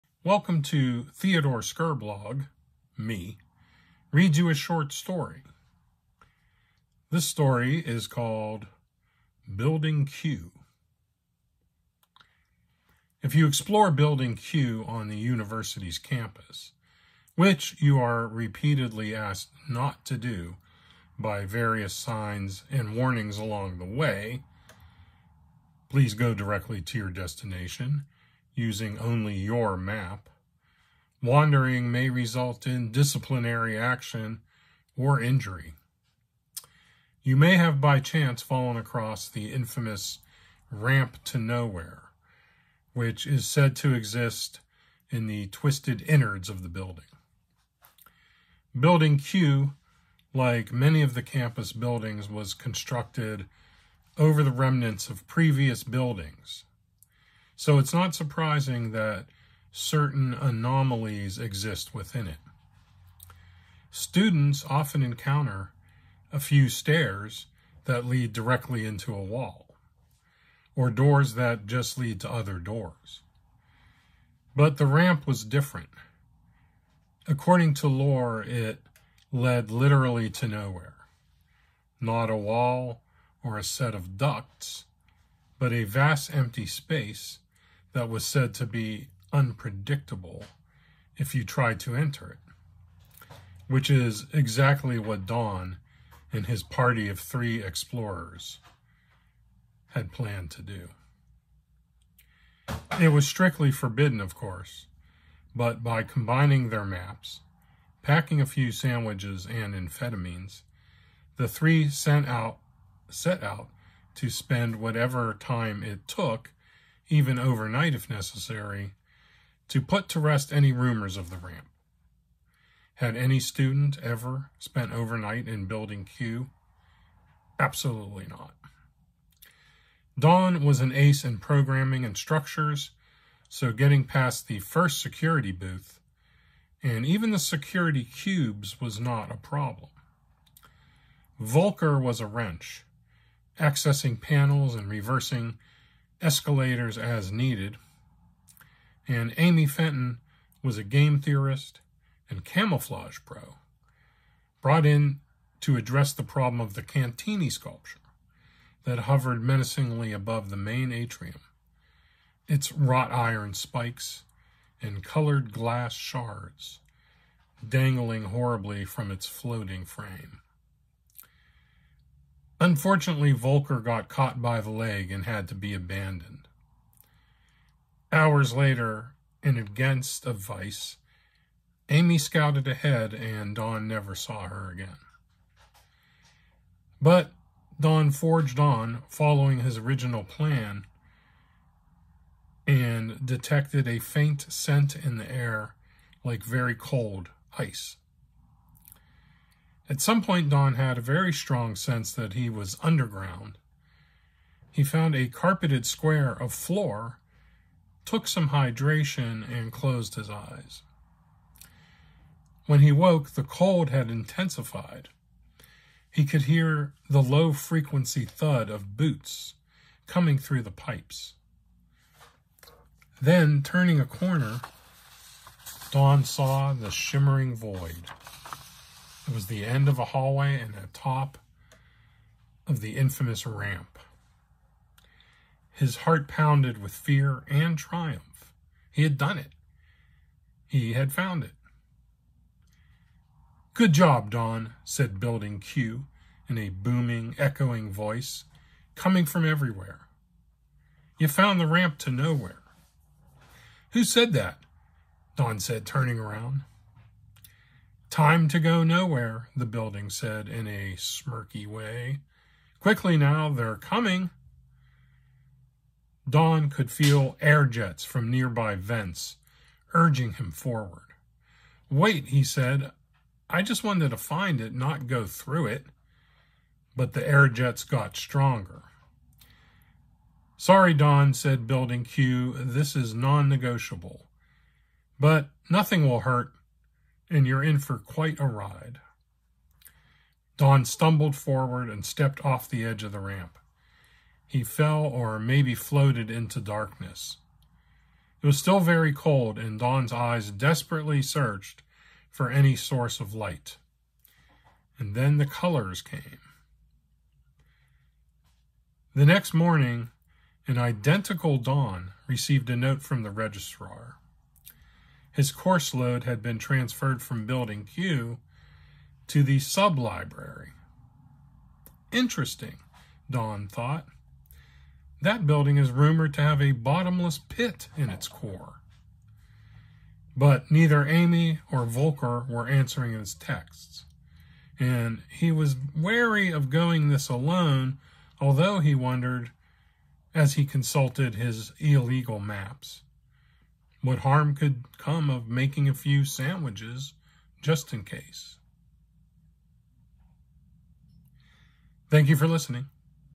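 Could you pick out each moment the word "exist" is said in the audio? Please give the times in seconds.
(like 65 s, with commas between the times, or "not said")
43 s, 61 s.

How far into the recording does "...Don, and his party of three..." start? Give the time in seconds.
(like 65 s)
95 s.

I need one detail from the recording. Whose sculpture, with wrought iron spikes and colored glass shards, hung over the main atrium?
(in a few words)
Cantini.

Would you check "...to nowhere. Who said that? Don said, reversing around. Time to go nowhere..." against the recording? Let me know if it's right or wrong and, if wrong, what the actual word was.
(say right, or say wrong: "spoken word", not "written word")
wrong: "turning", not "reversing".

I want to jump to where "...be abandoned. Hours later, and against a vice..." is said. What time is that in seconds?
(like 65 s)
175 s.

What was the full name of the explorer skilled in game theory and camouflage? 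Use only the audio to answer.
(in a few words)
Amy Fenton.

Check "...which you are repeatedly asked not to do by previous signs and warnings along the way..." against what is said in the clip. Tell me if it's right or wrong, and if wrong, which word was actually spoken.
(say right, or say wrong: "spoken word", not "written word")
wrong: "various", not "previous".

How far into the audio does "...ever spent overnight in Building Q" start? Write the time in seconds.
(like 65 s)
124 s.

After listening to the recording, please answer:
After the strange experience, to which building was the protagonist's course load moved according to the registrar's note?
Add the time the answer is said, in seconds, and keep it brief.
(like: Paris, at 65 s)
The sublibrary, at 319 s.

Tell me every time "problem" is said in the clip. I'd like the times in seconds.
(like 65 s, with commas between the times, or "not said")
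139 s, 156 s.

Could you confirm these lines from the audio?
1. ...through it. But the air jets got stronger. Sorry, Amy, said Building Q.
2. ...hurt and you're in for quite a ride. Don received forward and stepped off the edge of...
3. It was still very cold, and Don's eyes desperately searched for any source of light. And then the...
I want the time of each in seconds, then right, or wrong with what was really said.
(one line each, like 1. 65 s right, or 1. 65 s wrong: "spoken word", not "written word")
1. 275 s wrong: "Don", not "Amy"
2. 286 s wrong: "stumbled", not "received"
3. 298 s right.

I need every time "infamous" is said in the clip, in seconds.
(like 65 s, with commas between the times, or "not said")
39 s, 232 s.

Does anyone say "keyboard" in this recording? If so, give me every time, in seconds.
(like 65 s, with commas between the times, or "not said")
not said.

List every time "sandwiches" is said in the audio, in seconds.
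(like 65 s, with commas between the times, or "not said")
108 s, 346 s.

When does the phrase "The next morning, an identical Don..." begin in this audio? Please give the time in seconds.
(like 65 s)
309 s.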